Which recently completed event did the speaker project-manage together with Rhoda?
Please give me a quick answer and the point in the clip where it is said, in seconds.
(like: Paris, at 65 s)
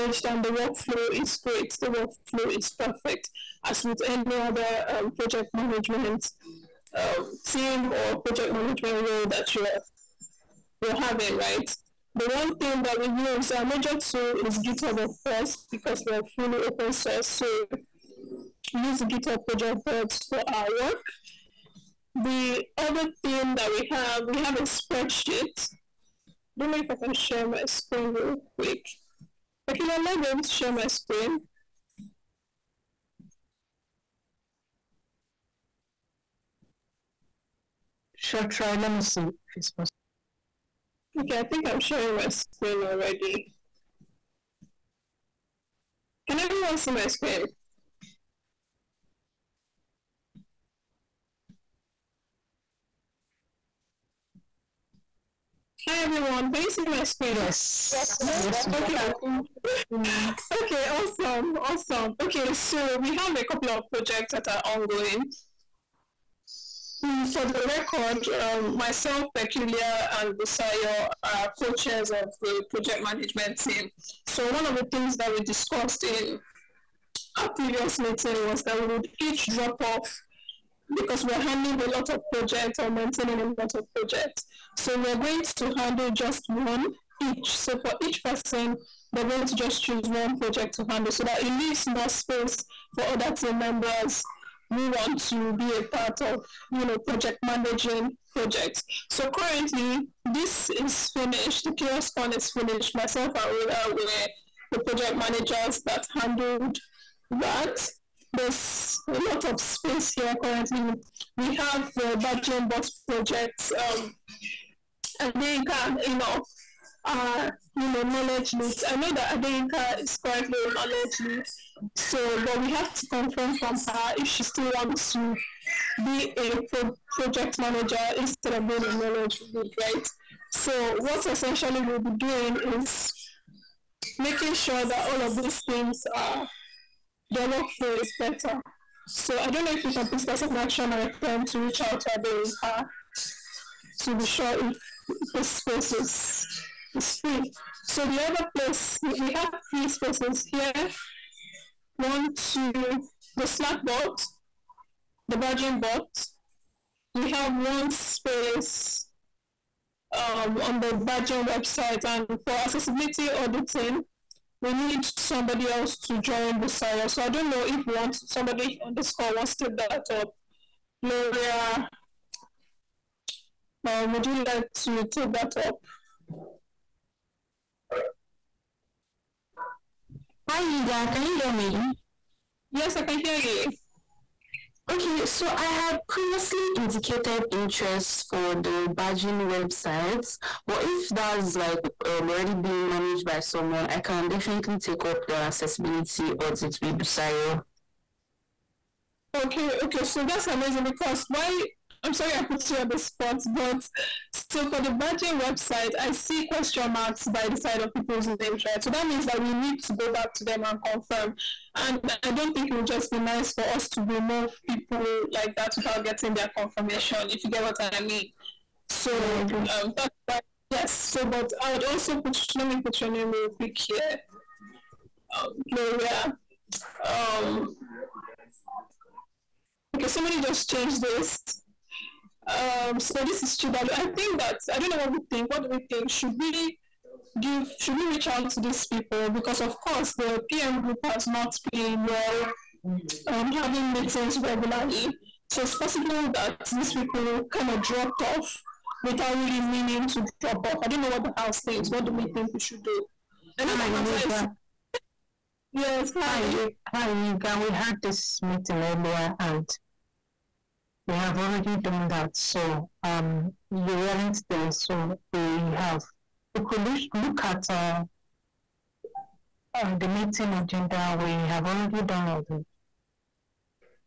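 CHAOSScon, at 101 s.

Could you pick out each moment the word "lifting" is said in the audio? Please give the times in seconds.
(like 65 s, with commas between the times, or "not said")
not said.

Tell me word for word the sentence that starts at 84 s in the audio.
So we're going to handle just one each.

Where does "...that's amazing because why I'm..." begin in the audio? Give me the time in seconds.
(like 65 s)
200 s.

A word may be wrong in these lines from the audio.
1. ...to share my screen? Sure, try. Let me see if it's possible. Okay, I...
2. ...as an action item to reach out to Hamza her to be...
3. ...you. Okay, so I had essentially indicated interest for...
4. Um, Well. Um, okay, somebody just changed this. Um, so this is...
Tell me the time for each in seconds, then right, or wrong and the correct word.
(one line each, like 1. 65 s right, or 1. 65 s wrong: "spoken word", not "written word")
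1. 30 s right
2. 140 s wrong: "Ade", not "Hamza"
3. 183 s wrong: "previously", not "essentially"
4. 225 s wrong: "Gloria", not "Well".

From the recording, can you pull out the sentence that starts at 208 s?
So that means that we need to go back to them and confirm.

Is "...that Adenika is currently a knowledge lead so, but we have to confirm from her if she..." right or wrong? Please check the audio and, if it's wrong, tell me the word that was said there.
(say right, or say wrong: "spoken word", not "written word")
right.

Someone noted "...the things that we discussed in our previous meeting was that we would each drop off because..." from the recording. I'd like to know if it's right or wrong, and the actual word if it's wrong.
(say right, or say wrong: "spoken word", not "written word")
right.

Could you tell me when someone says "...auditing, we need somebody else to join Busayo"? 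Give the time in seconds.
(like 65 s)
163 s.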